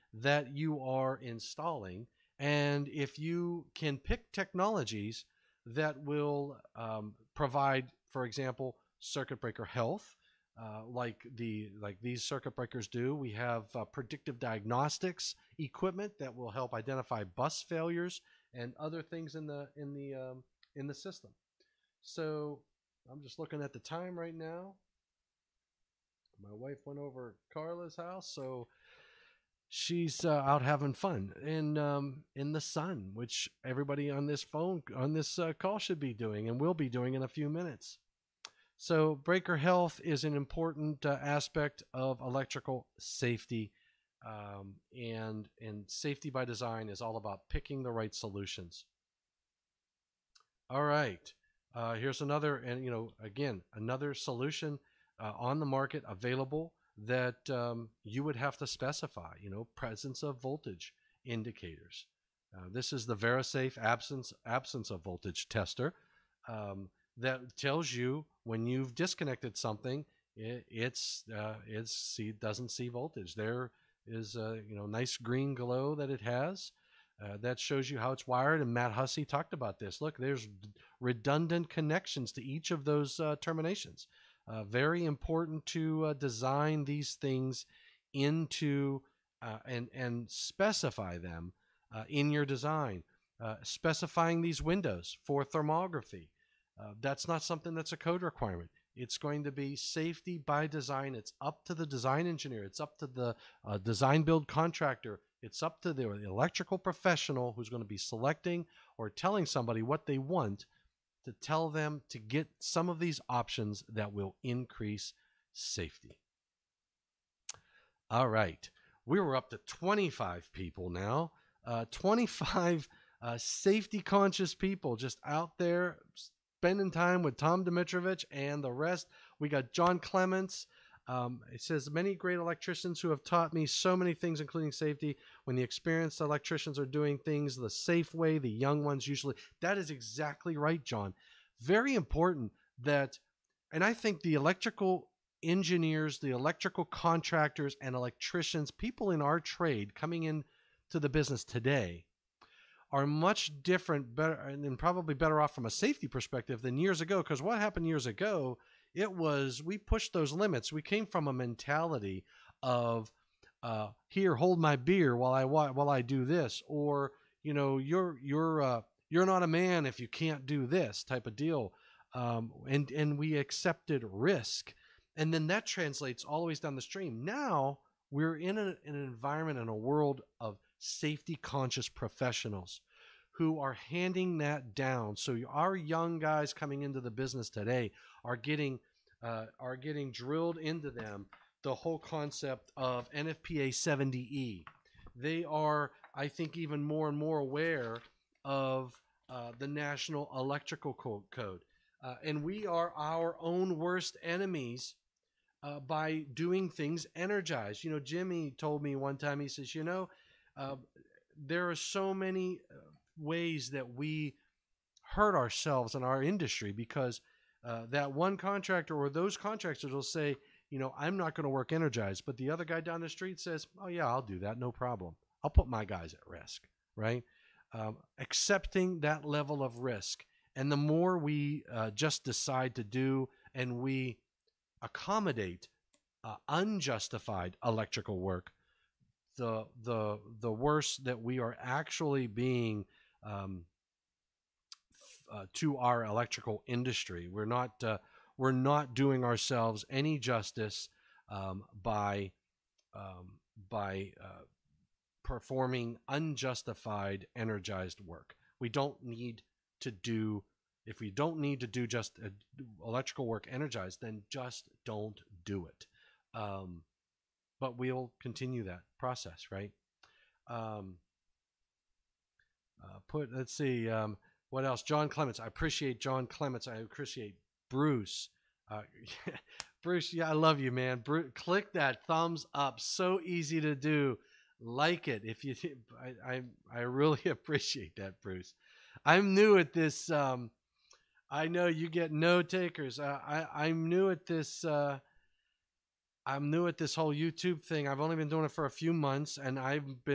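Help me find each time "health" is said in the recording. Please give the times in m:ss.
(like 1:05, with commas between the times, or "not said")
0:09, 0:39.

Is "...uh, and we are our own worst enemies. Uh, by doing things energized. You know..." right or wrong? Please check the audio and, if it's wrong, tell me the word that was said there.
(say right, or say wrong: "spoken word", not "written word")
right.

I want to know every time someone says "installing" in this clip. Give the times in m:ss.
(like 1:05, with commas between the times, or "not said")
0:01.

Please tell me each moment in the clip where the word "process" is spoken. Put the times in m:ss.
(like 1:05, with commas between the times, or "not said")
4:28.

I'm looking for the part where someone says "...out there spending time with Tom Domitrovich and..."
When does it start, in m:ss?
2:05.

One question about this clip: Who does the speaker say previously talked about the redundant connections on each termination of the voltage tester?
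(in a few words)
Matt Hussey.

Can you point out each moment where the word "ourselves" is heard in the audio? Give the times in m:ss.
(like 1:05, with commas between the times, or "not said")
3:35, 4:09.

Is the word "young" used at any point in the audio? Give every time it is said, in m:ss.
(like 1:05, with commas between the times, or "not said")
2:18, 3:05.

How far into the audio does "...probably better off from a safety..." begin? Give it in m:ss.
2:34.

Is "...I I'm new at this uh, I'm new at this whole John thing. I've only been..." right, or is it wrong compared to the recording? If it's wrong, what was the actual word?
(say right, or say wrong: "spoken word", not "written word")
wrong: "YouTube", not "John".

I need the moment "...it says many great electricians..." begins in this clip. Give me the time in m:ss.
2:11.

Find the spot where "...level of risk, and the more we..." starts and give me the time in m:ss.
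3:49.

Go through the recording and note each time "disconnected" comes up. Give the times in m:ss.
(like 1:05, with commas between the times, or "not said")
1:08.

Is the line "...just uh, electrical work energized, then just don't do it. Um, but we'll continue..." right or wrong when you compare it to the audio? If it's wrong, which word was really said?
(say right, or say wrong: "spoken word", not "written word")
right.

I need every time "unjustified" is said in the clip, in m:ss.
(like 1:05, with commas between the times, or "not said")
3:56, 4:16.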